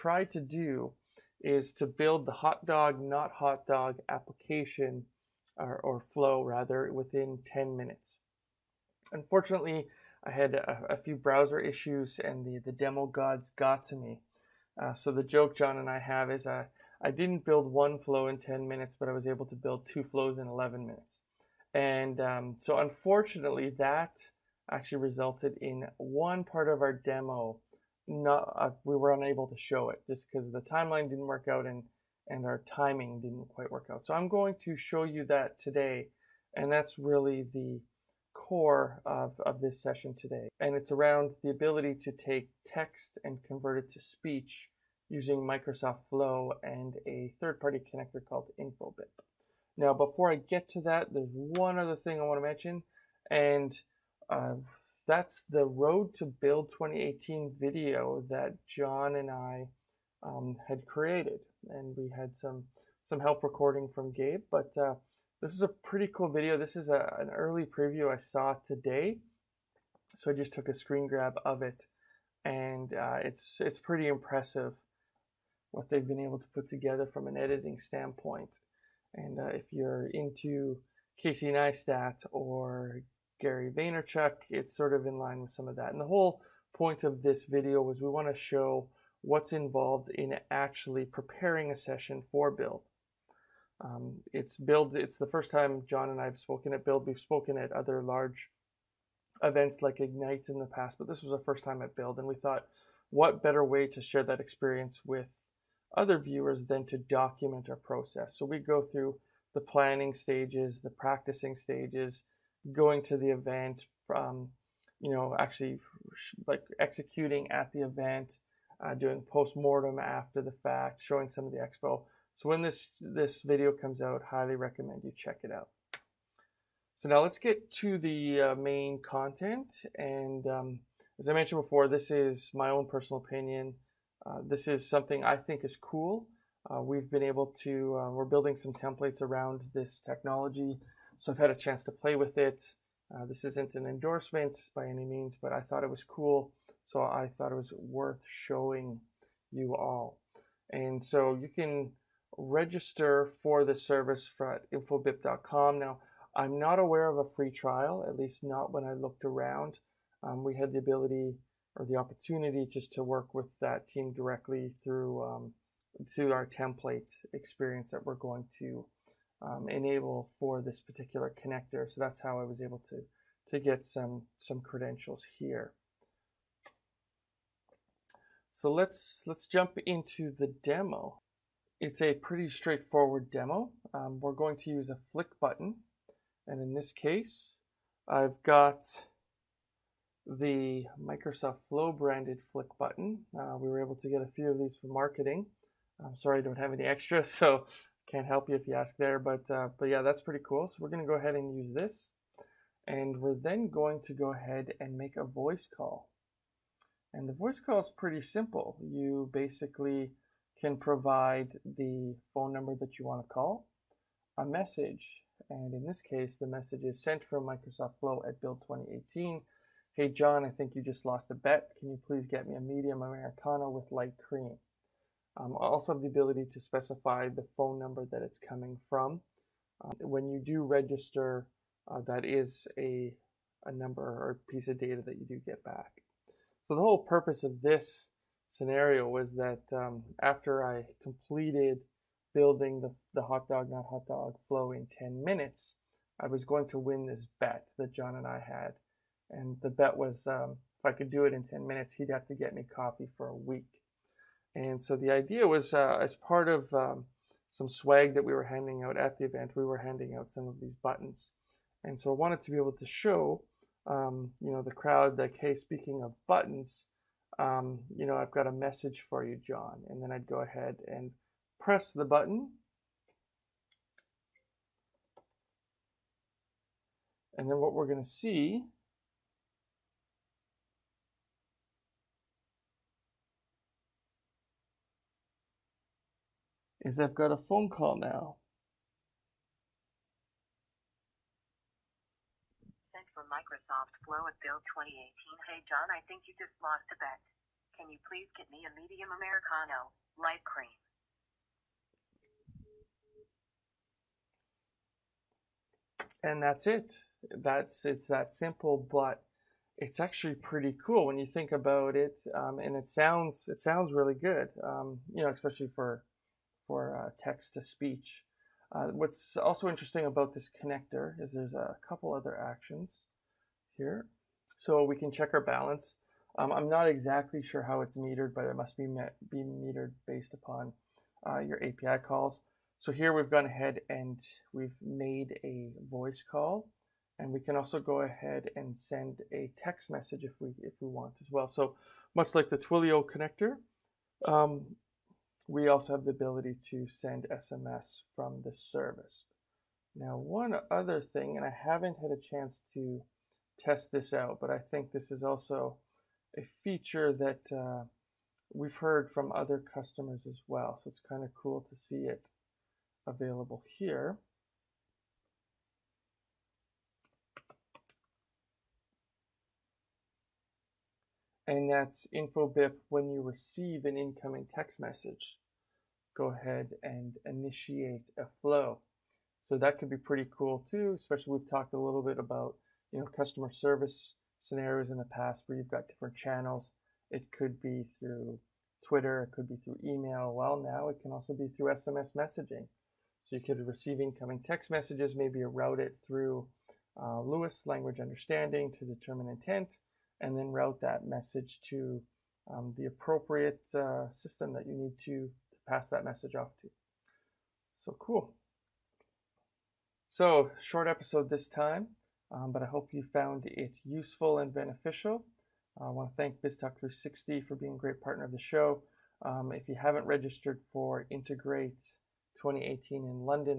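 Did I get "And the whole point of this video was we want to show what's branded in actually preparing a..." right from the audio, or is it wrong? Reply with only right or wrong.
wrong.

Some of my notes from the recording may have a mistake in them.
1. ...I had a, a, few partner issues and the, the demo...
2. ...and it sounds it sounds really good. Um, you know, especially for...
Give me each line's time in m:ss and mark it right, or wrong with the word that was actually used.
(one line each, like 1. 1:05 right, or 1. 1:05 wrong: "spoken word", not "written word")
1. 0:10 wrong: "browser", not "partner"
2. 5:12 right.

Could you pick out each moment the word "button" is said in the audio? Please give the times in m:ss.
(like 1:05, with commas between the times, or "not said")
3:05, 3:12, 4:20, 4:26, 4:32.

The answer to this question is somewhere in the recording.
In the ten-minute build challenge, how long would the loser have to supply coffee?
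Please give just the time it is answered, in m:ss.
4:13.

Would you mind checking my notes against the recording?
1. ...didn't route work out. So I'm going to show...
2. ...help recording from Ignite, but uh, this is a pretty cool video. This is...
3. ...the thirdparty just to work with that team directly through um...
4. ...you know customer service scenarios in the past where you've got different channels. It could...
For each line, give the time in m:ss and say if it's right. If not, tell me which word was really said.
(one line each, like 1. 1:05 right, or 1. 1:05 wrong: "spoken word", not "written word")
1. 0:33 wrong: "quite", not "route"
2. 1:03 wrong: "Gabe", not "Ignite"
3. 2:41 wrong: "opportunity", not "thirdparty"
4. 6:22 right.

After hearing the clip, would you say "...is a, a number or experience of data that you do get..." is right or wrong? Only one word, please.
wrong.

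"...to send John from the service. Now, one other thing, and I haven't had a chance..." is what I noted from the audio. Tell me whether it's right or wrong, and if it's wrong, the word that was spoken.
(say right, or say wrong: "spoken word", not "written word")
wrong: "SMS", not "John".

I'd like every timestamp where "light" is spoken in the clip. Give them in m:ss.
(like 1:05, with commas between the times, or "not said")
3:43, 5:00.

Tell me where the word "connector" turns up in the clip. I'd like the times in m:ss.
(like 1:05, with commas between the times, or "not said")
0:47, 2:51, 5:20, 5:43.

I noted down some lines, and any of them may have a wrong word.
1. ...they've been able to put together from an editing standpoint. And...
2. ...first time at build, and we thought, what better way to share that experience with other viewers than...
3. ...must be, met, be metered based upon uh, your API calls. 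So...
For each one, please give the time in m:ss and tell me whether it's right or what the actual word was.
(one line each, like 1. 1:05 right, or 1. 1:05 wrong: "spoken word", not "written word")
1. 1:15 right
2. 1:41 right
3. 5:28 right.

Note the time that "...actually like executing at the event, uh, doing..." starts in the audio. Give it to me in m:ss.
1:55.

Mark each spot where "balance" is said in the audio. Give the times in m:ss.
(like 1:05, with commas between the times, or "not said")
5:25.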